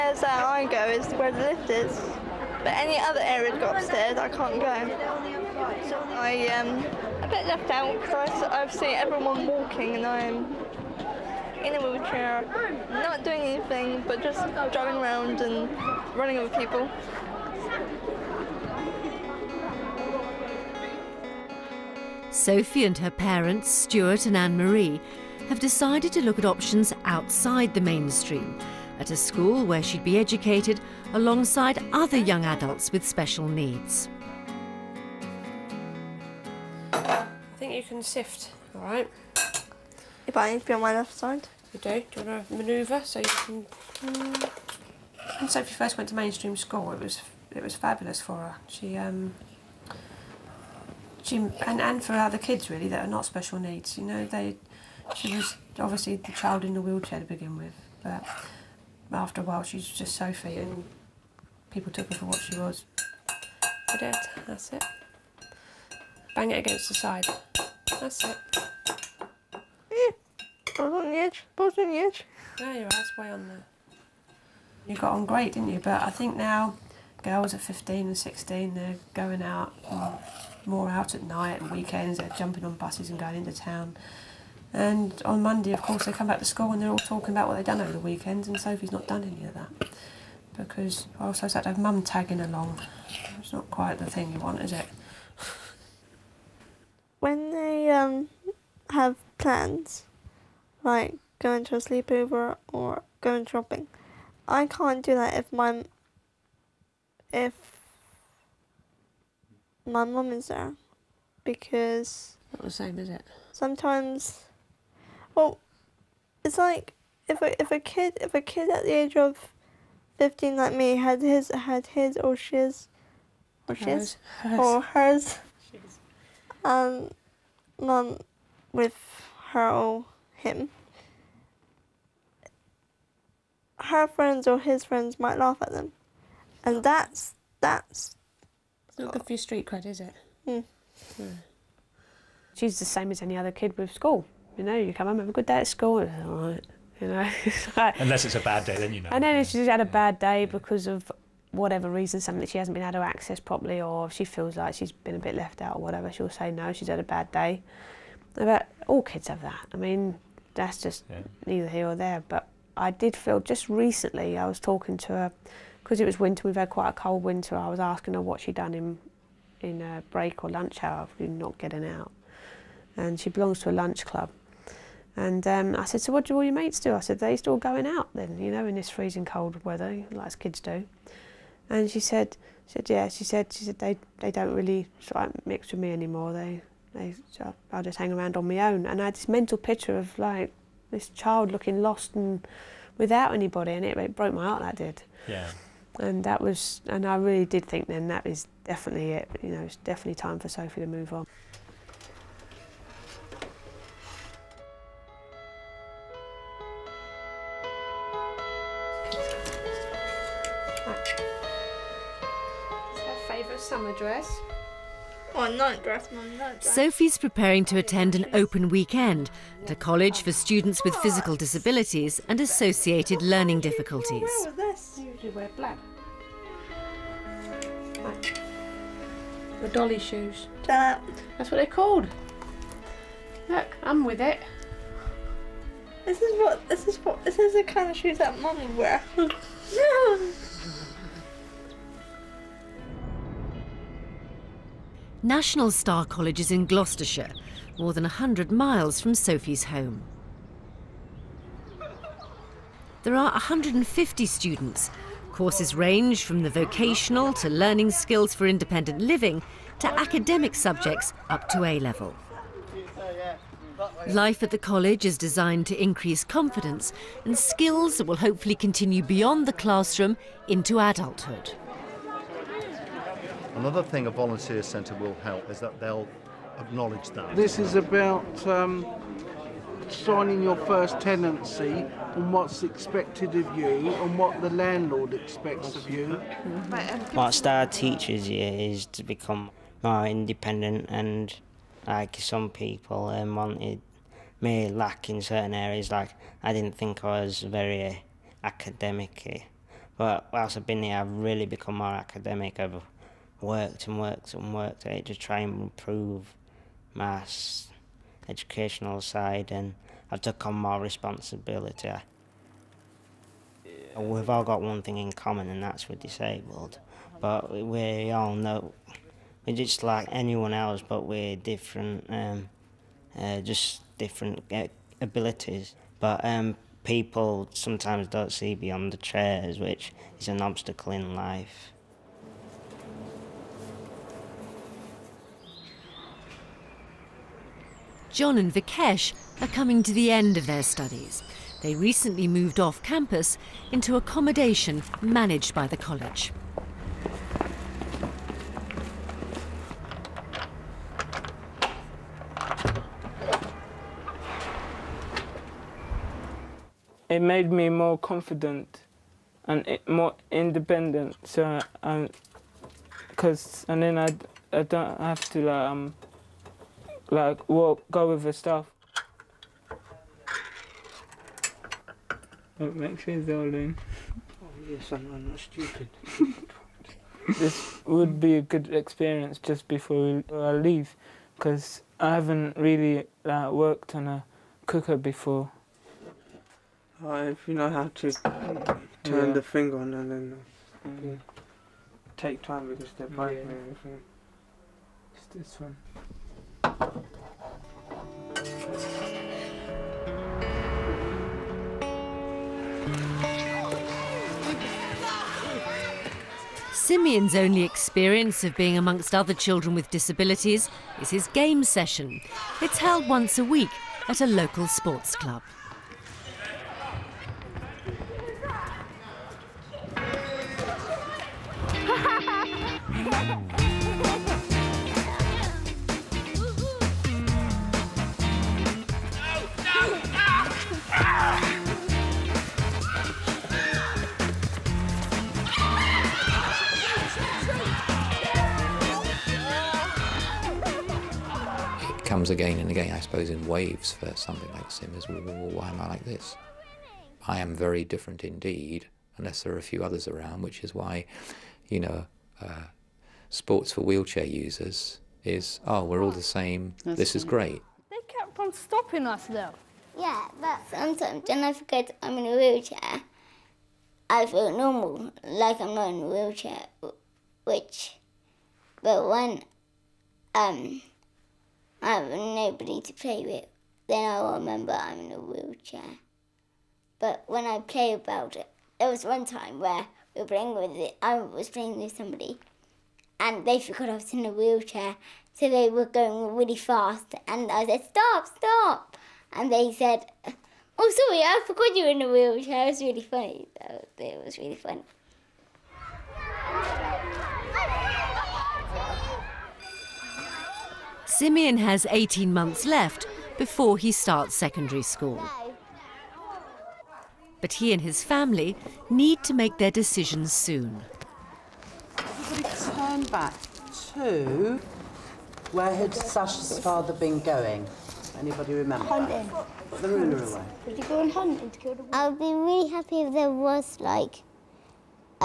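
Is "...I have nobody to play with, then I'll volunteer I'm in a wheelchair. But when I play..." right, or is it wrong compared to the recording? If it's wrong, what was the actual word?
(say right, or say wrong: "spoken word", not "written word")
wrong: "remember", not "volunteer".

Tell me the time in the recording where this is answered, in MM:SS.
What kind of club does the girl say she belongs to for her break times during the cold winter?
02:53.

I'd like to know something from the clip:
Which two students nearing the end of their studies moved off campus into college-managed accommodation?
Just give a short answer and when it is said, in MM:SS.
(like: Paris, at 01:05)
John and Vikesh, at 05:38.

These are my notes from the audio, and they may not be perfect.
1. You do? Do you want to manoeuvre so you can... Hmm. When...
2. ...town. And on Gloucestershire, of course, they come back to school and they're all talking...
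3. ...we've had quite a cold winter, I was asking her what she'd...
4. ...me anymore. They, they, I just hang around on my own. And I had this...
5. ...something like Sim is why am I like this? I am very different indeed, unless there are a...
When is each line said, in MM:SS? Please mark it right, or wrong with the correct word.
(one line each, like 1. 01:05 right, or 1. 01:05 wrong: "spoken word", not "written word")
1. 00:41 right
2. 01:23 wrong: "Monday", not "Gloucestershire"
3. 02:46 right
4. 03:05 right
5. 07:24 right.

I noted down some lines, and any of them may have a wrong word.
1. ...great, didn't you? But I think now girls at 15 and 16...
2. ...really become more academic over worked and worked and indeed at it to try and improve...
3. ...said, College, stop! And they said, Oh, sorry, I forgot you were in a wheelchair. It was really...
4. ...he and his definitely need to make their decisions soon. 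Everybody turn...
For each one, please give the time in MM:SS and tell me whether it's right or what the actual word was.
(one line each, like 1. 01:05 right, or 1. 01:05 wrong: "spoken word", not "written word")
1. 01:15 right
2. 05:01 wrong: "worked", not "indeed"
3. 08:07 wrong: "Stop", not "College"
4. 08:27 wrong: "family", not "definitely".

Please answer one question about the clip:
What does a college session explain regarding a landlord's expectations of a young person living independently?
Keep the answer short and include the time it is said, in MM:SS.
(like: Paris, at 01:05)
first tenancy, at 04:40.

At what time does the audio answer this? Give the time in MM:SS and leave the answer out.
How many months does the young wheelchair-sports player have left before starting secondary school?
08:21.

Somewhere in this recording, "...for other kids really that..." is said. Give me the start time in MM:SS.
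00:52.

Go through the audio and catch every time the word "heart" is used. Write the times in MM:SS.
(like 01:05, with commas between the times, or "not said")
03:14.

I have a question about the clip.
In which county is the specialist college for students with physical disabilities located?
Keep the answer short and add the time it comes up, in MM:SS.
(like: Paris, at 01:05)
Gloucestershire, at 04:06.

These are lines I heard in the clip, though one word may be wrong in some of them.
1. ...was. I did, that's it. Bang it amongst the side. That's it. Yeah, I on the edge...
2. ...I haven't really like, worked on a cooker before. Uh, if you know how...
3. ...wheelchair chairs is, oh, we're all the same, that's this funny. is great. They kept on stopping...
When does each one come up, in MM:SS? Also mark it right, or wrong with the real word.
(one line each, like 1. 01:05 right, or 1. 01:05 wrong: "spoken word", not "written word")
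1. 01:02 wrong: "against", not "amongst"
2. 06:21 right
3. 07:33 wrong: "users", not "chairs".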